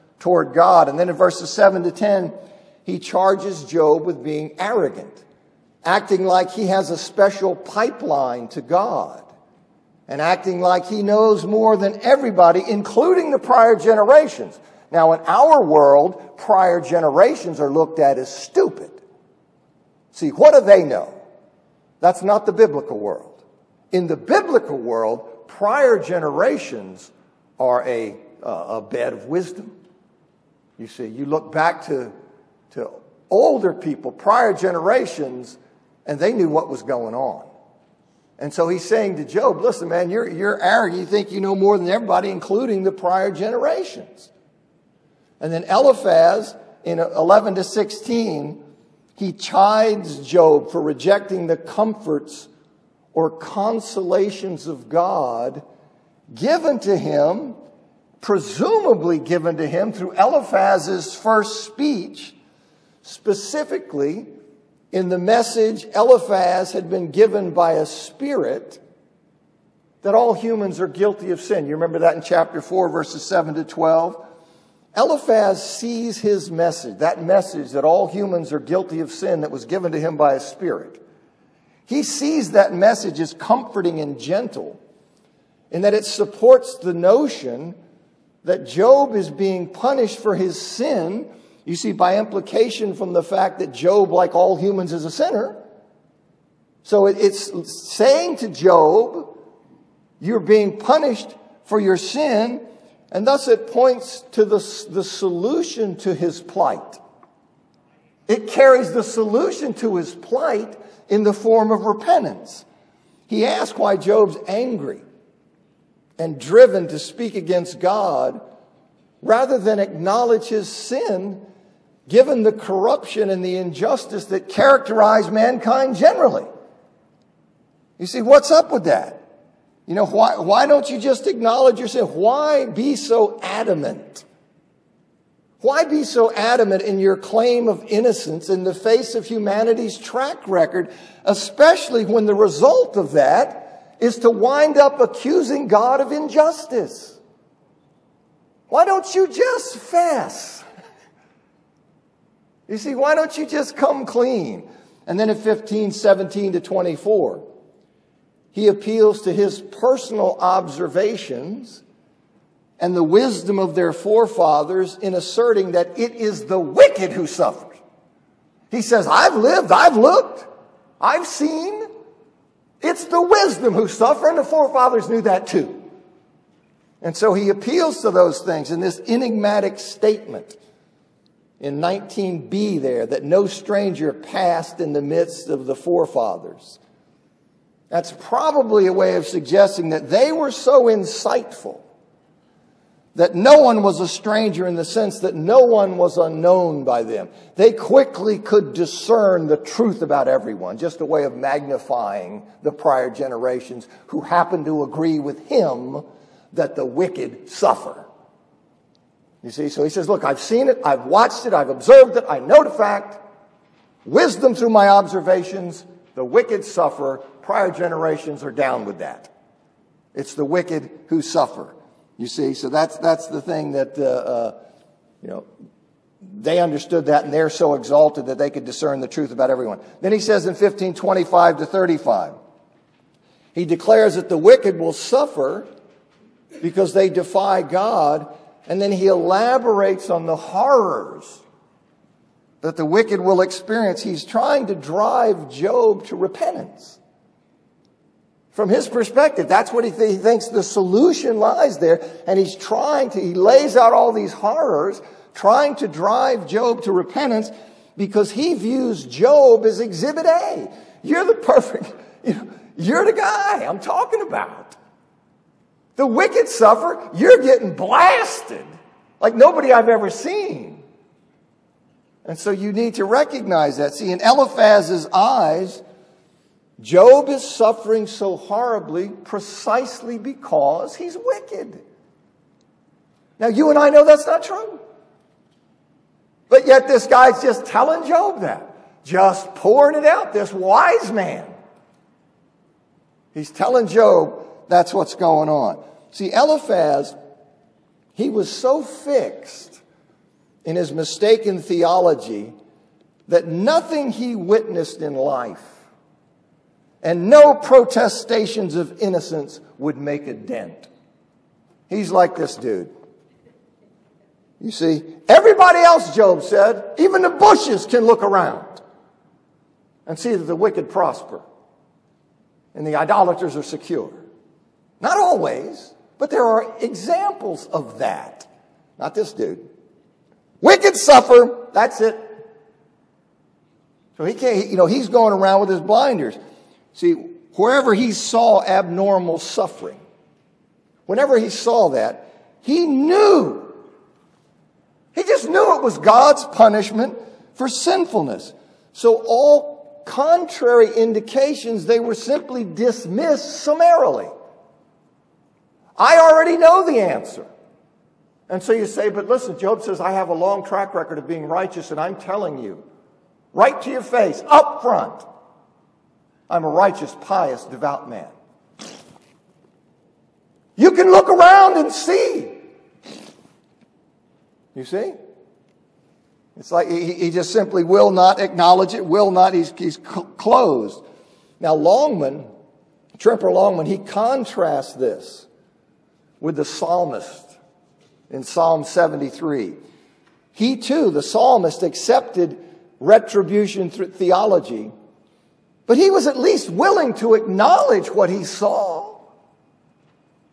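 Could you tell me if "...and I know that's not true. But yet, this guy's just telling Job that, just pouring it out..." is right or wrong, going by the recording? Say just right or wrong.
right.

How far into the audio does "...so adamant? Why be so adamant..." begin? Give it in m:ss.
2:12.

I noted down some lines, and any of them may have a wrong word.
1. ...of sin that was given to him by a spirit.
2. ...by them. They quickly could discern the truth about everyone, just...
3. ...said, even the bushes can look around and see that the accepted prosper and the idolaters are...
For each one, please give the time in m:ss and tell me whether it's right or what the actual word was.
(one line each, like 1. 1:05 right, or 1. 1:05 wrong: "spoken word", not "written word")
1. 1:19 right
2. 3:16 right
3. 5:16 wrong: "wicked", not "accepted".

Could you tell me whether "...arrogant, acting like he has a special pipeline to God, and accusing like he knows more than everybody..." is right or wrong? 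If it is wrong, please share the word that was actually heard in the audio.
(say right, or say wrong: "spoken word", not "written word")
wrong: "acting", not "accusing".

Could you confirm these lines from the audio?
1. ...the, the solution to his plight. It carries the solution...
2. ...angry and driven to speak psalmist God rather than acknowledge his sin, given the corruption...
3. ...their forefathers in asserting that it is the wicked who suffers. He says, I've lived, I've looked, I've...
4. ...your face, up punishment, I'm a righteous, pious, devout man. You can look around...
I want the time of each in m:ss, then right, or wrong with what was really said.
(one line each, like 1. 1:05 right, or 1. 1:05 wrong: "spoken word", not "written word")
1. 1:44 right
2. 1:54 wrong: "against", not "psalmist"
3. 2:43 right
4. 6:03 wrong: "front", not "punishment".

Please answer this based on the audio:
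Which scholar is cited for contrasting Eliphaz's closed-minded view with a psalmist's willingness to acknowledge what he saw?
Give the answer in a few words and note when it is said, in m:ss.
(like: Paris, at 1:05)
Tremper Longman, at 6:23.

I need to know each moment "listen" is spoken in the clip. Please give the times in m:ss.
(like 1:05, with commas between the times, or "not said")
0:39, 5:59.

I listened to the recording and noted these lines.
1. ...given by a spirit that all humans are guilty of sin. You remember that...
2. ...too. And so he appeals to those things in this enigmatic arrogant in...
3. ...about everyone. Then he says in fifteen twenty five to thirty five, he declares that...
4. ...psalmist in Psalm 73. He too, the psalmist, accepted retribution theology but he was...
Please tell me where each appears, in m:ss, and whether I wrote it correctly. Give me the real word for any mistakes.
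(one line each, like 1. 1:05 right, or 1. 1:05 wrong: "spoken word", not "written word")
1. 1:07 right
2. 2:55 wrong: "statement", not "arrogant"
3. 3:49 right
4. 6:26 right.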